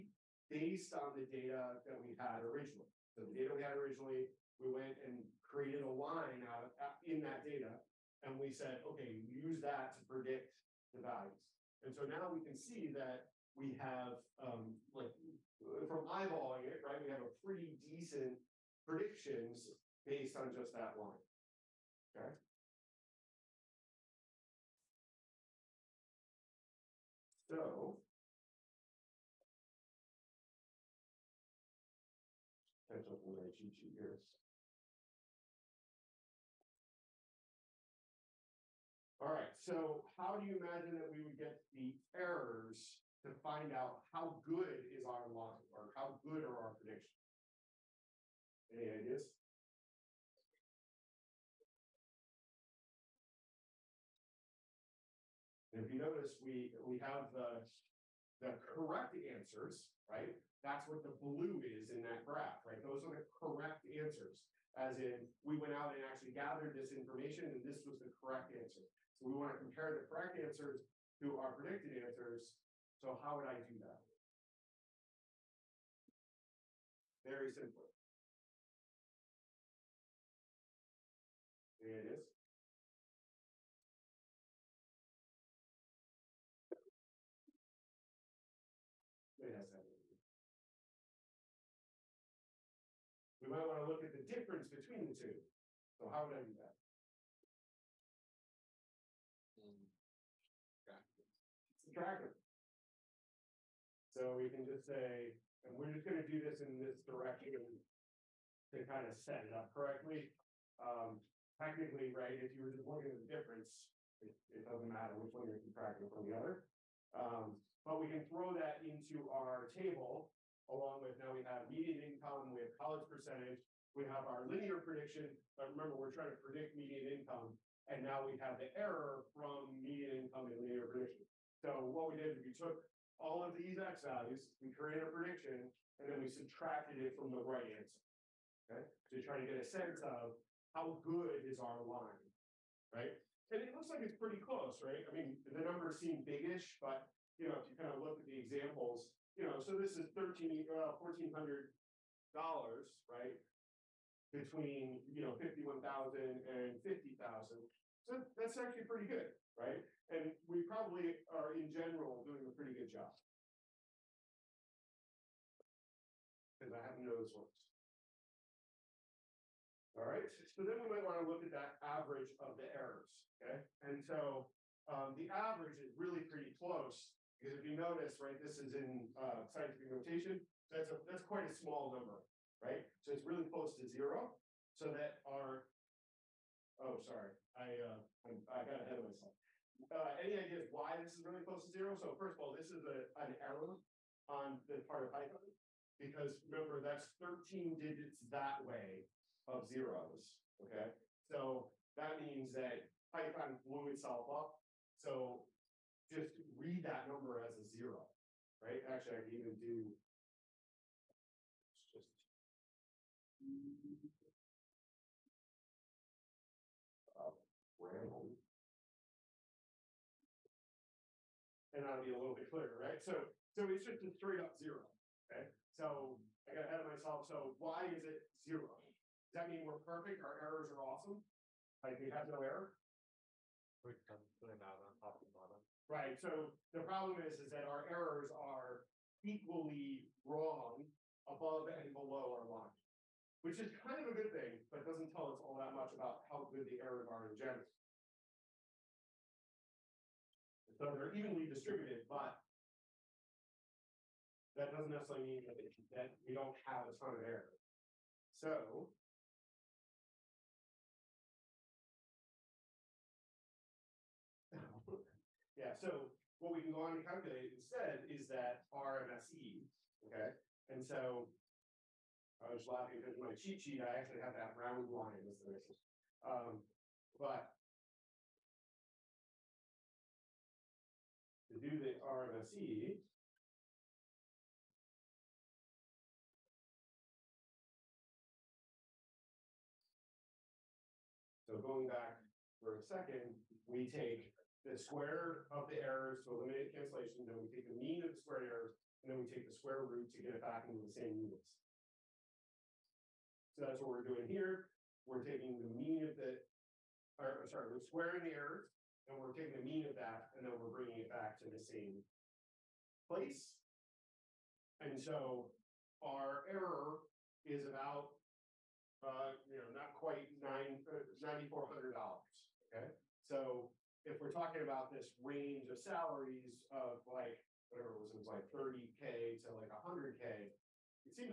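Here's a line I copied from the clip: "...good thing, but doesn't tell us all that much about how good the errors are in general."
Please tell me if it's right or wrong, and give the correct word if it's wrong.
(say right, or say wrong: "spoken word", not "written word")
right.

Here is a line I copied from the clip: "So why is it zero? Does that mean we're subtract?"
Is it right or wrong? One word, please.
wrong.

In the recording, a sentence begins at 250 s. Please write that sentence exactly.
So they're evenly distributed, but that doesn't necessarily mean that, that we don't have a ton of error.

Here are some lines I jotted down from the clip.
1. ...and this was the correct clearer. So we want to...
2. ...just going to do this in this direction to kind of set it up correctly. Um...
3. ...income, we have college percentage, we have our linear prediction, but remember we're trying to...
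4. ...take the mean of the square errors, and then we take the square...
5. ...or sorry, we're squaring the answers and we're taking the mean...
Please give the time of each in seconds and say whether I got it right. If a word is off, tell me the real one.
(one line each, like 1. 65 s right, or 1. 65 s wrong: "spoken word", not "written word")
1. 67 s wrong: "answer", not "clearer"
2. 105 s right
3. 122 s right
4. 297 s right
5. 307 s wrong: "errors", not "answers".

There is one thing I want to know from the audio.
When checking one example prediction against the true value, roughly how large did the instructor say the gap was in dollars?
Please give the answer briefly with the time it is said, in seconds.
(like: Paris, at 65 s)
$1,400, at 150 s.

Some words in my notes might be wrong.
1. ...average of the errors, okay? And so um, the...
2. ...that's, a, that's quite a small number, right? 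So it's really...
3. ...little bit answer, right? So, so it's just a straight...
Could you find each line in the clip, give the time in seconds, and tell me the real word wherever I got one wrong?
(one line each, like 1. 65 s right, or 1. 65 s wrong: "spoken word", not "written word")
1. 171 s right
2. 180 s right
3. 222 s wrong: "clearer", not "answer".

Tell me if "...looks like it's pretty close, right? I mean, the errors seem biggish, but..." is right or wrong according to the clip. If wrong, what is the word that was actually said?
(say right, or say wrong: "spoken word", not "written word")
wrong: "numbers", not "errors".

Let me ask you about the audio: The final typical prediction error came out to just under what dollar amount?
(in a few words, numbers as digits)
$9,400.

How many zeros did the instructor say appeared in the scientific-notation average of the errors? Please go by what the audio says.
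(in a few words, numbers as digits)
13.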